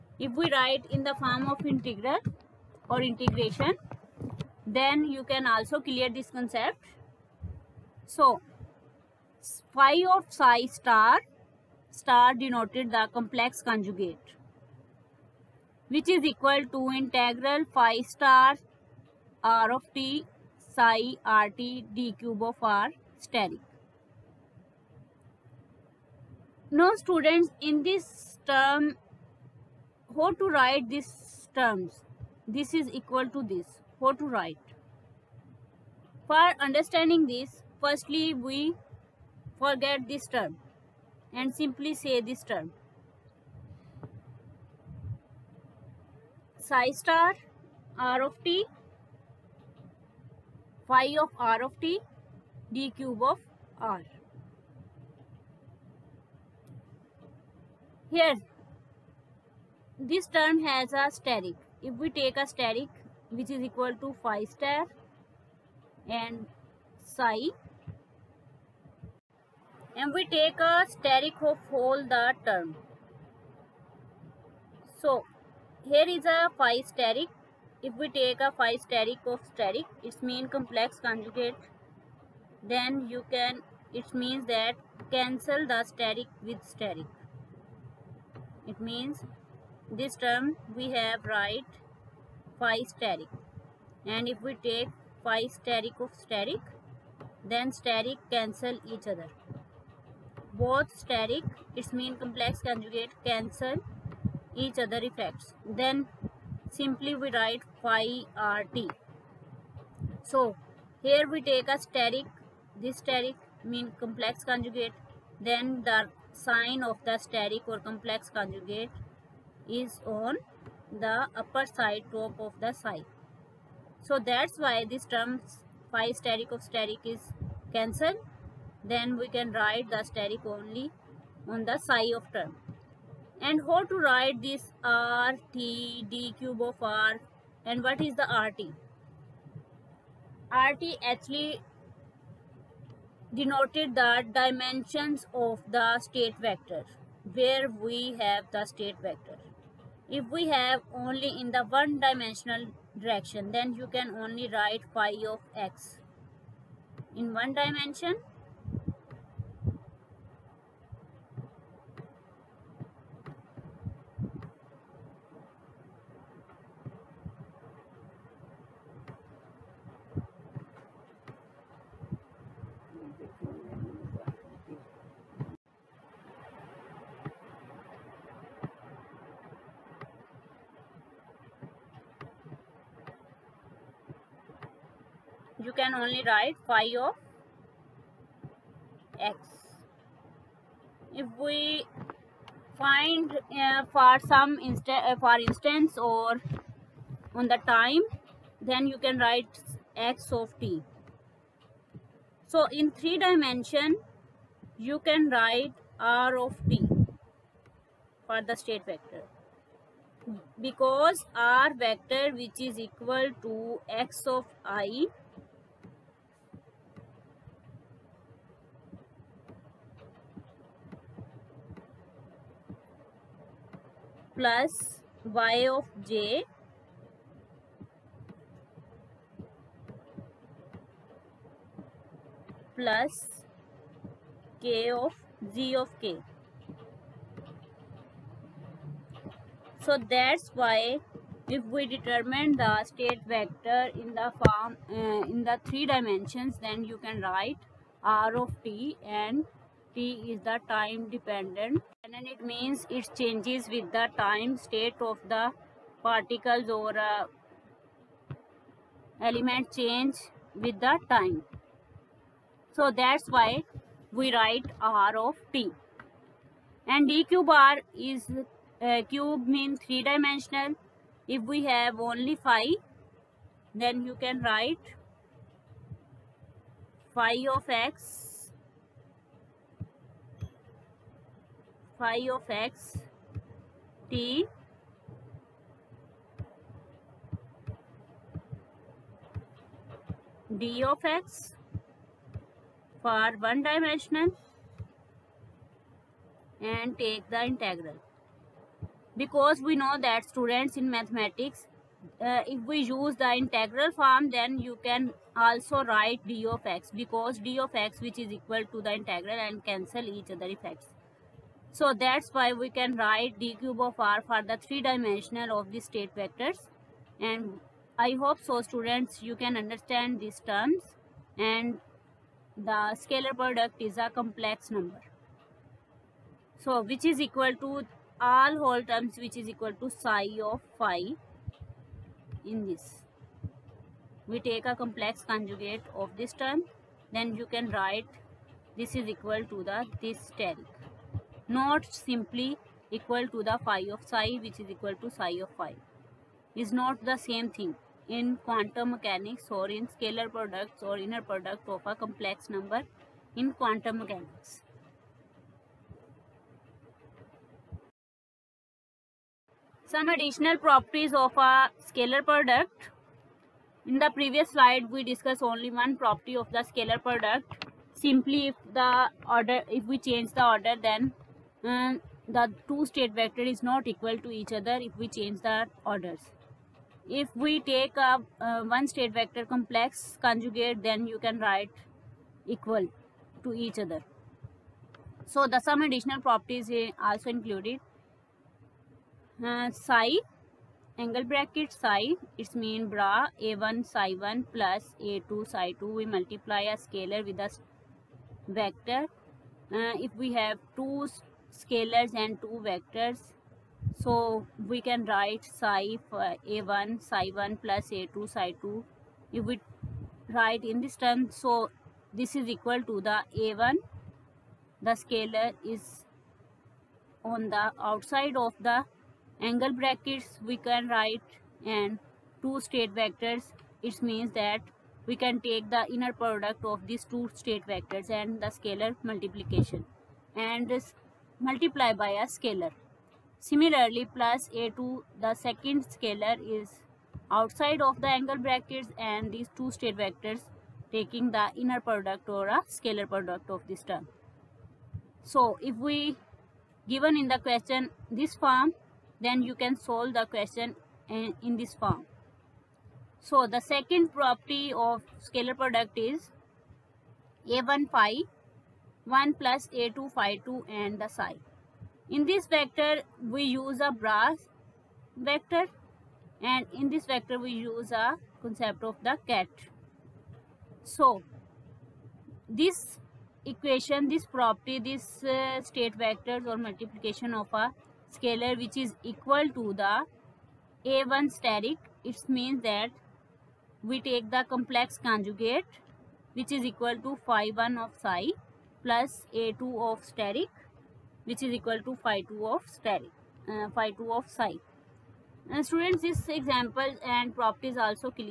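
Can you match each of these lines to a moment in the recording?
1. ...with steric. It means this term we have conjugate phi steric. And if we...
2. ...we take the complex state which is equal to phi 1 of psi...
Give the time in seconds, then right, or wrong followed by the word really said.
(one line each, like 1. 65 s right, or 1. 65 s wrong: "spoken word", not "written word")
1. 86 s wrong: "write", not "conjugate"
2. 483 s wrong: "conjugate", not "state".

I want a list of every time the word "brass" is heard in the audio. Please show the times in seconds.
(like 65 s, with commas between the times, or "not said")
463 s.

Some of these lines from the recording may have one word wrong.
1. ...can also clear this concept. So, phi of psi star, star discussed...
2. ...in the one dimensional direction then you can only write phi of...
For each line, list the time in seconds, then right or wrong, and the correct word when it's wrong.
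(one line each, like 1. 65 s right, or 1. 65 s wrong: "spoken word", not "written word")
1. 5 s wrong: "denoted", not "discussed"
2. 151 s right.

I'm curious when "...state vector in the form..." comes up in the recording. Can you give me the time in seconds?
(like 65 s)
242 s.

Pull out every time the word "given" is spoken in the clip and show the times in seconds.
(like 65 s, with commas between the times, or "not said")
446 s.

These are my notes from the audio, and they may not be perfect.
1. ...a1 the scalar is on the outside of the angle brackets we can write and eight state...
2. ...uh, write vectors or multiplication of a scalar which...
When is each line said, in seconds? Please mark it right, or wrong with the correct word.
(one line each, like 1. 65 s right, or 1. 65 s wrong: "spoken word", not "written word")
1. 413 s wrong: "two", not "eight"
2. 475 s wrong: "state", not "write".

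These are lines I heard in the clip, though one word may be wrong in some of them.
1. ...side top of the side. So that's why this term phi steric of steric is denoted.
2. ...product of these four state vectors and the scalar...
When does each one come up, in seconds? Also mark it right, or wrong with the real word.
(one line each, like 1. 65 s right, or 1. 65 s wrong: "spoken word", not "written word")
1. 121 s wrong: "cancelled", not "denoted"
2. 426 s wrong: "two", not "four".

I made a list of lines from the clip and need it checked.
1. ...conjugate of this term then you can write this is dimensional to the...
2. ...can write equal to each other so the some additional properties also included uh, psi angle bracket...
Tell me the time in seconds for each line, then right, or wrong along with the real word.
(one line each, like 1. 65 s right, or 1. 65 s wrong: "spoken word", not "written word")
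1. 335 s wrong: "equal", not "dimensional"
2. 381 s right.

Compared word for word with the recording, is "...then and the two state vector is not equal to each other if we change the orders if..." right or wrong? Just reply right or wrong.
right.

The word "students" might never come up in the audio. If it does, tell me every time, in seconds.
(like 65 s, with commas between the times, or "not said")
27 s, 300 s, 318 s, 495 s.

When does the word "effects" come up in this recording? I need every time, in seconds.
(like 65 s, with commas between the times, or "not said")
105 s, 310 s.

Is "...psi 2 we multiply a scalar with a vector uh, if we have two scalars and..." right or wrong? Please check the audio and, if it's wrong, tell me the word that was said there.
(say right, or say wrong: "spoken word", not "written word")
right.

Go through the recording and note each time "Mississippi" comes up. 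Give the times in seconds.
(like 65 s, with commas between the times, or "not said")
not said.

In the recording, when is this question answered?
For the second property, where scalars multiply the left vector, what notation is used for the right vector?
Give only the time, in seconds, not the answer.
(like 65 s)
469 s.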